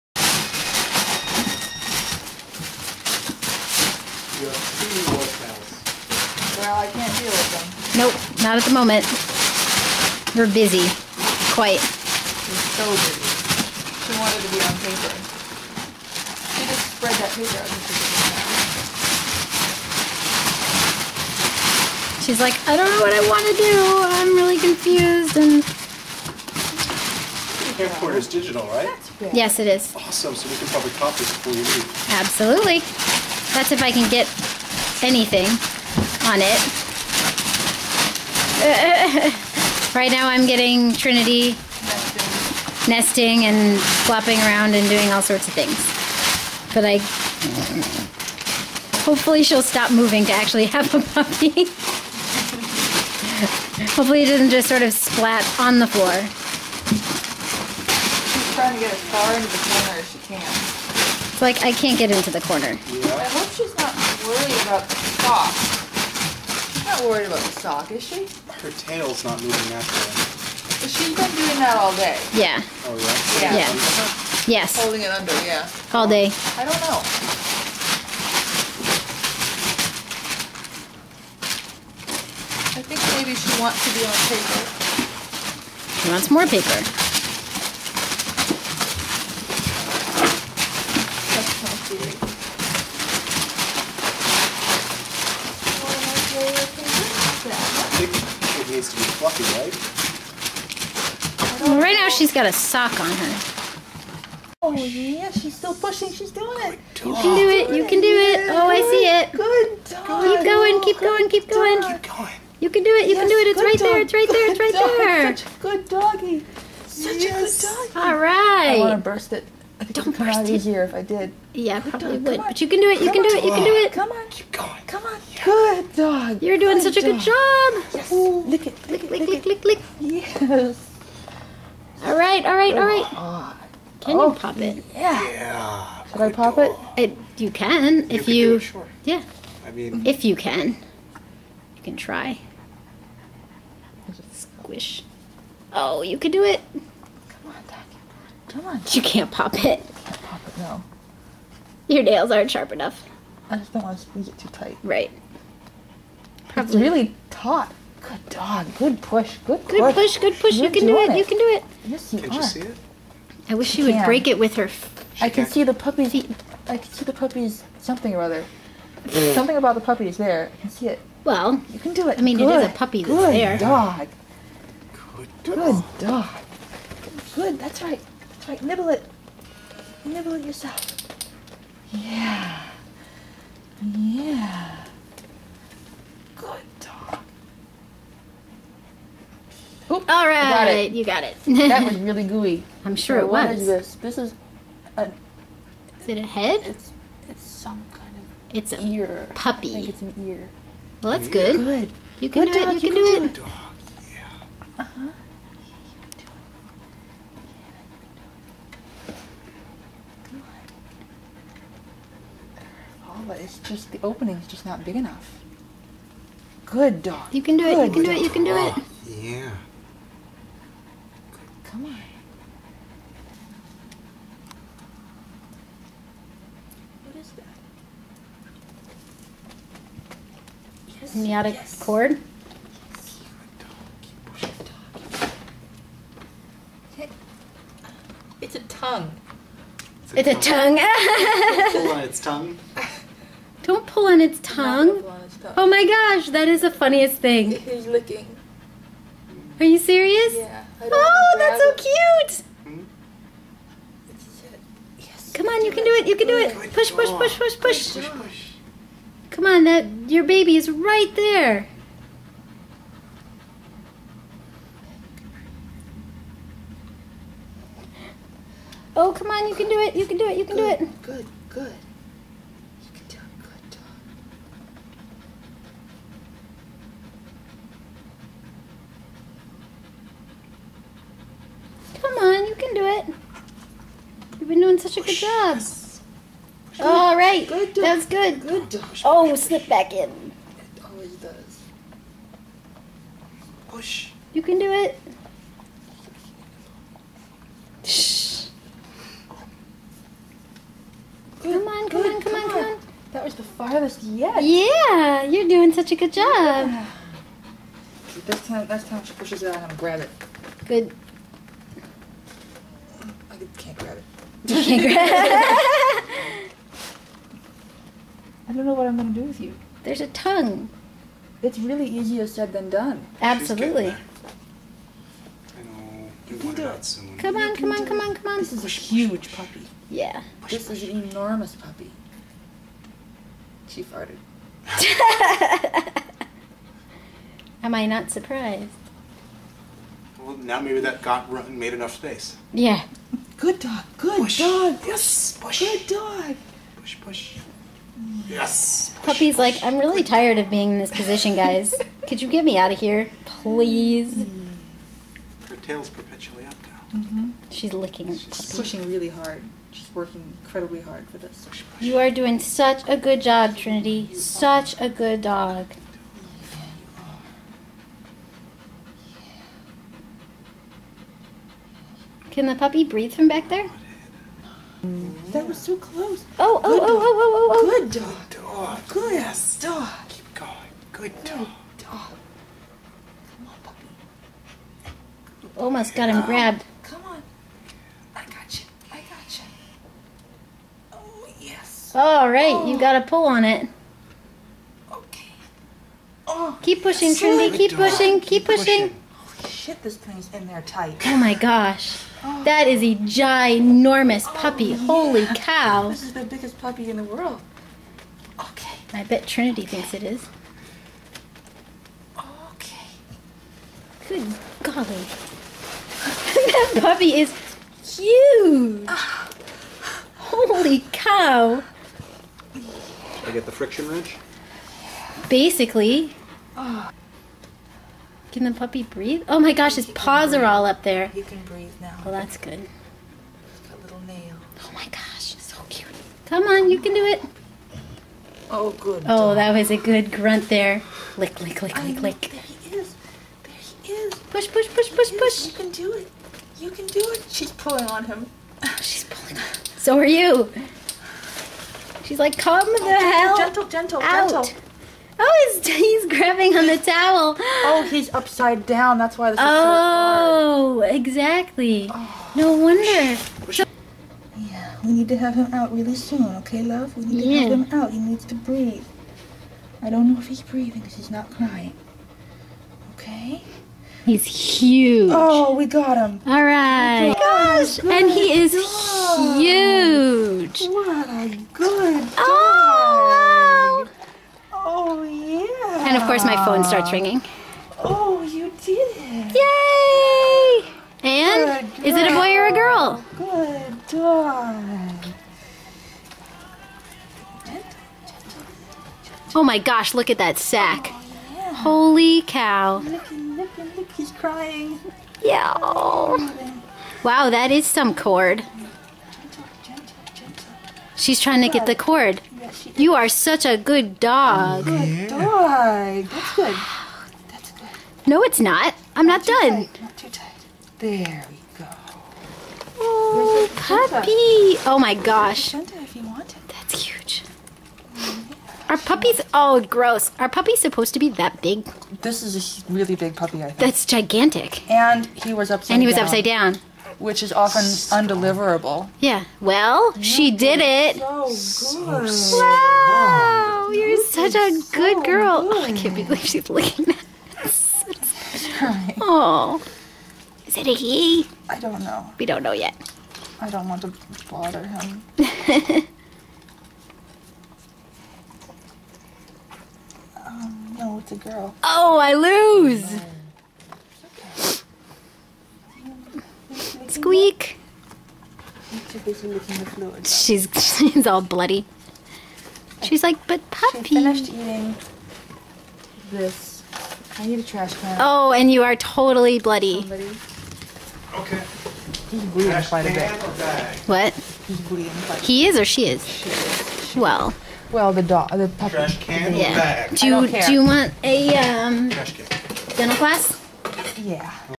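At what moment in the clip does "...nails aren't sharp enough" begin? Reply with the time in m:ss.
2:32.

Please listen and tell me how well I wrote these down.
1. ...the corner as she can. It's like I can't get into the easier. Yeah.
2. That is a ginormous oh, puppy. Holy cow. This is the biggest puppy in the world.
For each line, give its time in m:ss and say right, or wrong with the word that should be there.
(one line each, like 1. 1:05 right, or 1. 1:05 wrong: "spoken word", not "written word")
1. 0:59 wrong: "corner", not "easier"
2. 6:42 right.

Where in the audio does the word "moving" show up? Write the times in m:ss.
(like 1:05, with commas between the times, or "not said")
0:49, 1:09.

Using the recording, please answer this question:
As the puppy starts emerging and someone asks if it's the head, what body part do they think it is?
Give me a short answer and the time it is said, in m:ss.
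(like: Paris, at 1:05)
ear, at 3:19.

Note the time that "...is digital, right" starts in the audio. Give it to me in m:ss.
0:28.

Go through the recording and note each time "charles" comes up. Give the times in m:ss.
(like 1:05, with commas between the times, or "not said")
not said.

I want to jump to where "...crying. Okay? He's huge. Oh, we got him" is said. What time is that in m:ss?
7:51.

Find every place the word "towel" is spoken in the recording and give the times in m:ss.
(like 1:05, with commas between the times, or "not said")
7:36.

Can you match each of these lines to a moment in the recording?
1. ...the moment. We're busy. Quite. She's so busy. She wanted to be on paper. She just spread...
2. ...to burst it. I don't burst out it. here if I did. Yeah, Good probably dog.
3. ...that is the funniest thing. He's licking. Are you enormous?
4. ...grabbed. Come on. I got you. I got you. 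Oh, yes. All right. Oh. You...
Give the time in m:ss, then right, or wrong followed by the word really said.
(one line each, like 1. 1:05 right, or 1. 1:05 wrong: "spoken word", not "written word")
1. 0:08 right
2. 1:59 right
3. 4:06 wrong: "serious", not "enormous"
4. 6:26 right.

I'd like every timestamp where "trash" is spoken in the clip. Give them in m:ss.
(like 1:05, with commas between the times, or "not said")
9:37, 9:48.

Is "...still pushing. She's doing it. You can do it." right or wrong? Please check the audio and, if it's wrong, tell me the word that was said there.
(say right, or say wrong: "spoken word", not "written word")
right.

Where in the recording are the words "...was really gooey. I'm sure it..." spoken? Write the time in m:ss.
3:11.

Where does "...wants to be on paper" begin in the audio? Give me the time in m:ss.
1:23.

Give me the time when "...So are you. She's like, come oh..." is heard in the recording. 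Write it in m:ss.
7:29.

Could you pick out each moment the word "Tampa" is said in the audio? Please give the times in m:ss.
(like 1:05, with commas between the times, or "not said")
not said.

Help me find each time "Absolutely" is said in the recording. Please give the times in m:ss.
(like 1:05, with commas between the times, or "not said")
0:32, 5:23.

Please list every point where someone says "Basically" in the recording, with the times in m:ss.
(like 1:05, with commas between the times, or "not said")
7:05.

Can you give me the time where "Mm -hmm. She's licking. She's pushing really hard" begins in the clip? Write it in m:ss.
5:56.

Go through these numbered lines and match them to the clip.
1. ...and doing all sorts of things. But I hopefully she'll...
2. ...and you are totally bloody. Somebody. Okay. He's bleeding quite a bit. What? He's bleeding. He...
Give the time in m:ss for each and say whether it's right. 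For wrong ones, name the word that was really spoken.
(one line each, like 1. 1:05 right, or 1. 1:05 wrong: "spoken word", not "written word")
1. 0:44 right
2. 9:38 right.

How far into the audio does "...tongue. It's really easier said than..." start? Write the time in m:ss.
5:20.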